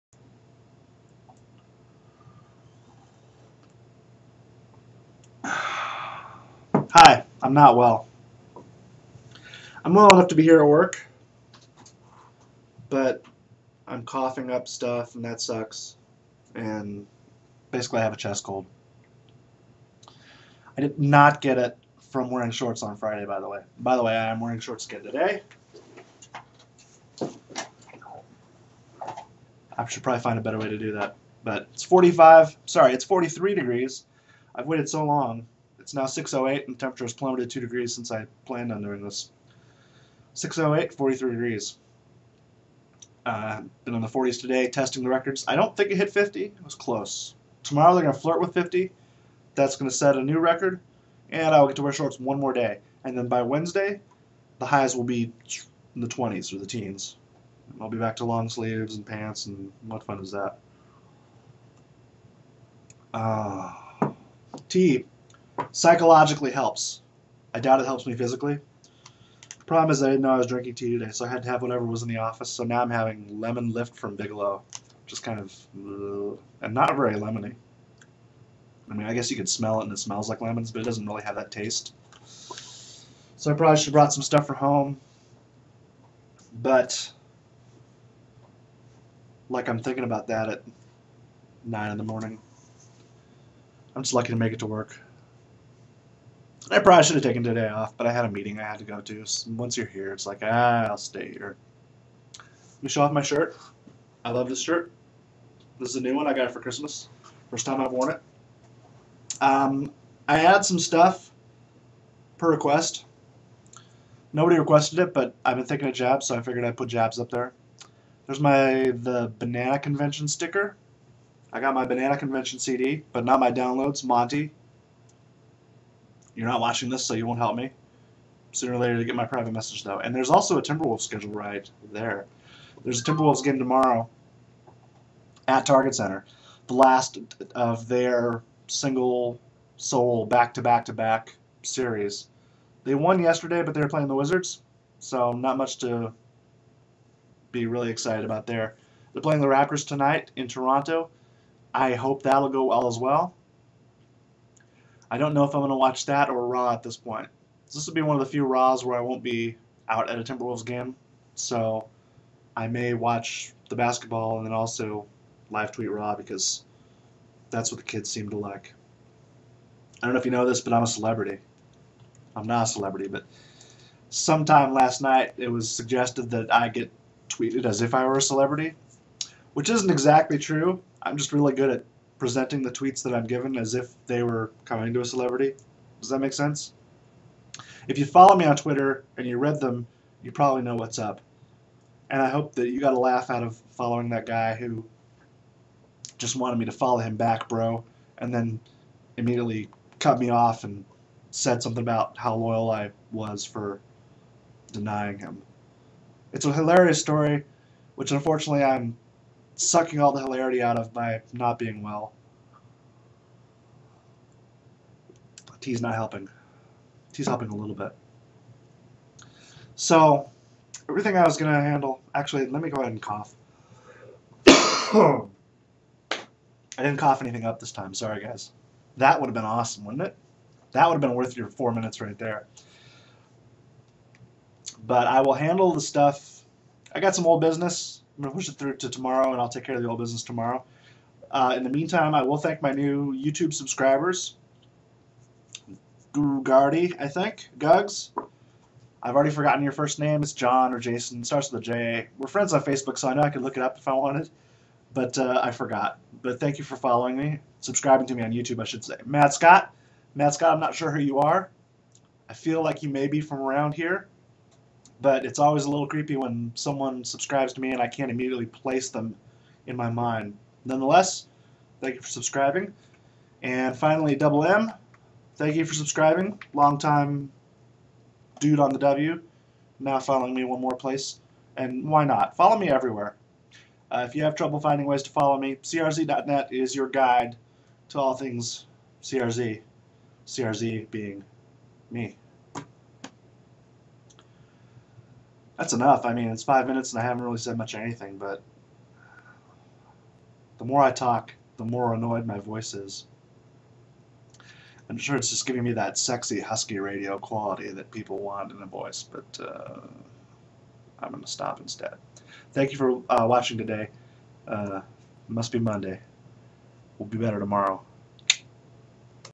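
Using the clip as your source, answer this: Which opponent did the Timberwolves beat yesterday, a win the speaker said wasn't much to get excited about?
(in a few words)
Wizards.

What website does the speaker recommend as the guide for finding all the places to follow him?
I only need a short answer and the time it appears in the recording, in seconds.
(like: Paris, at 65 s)
crz.net, at 285 s.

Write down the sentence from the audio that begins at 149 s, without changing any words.
They're playing the Raptors tonight in Toronto.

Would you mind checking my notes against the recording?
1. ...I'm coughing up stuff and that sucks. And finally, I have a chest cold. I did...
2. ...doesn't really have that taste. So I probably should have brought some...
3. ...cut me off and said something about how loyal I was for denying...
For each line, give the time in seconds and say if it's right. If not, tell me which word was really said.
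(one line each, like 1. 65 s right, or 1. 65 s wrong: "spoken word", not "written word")
1. 13 s wrong: "basically", not "finally"
2. 80 s right
3. 199 s right.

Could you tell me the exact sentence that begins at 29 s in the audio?
I should probably find a better way to do that.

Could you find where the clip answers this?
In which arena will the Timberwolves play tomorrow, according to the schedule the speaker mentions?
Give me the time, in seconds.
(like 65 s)
135 s.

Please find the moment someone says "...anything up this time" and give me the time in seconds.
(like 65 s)
227 s.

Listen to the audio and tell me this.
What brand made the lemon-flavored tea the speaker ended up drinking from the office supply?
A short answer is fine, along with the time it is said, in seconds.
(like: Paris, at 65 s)
Bigelow, at 74 s.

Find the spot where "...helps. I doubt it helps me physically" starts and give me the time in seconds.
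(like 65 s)
66 s.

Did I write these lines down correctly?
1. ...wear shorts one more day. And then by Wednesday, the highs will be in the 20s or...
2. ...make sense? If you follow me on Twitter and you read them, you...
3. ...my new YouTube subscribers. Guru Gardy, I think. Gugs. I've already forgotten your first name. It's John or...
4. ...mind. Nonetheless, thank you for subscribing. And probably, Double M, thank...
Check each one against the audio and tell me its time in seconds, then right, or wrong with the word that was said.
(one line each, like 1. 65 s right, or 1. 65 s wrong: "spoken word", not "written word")
1. 51 s right
2. 186 s right
3. 242 s right
4. 269 s wrong: "finally", not "probably".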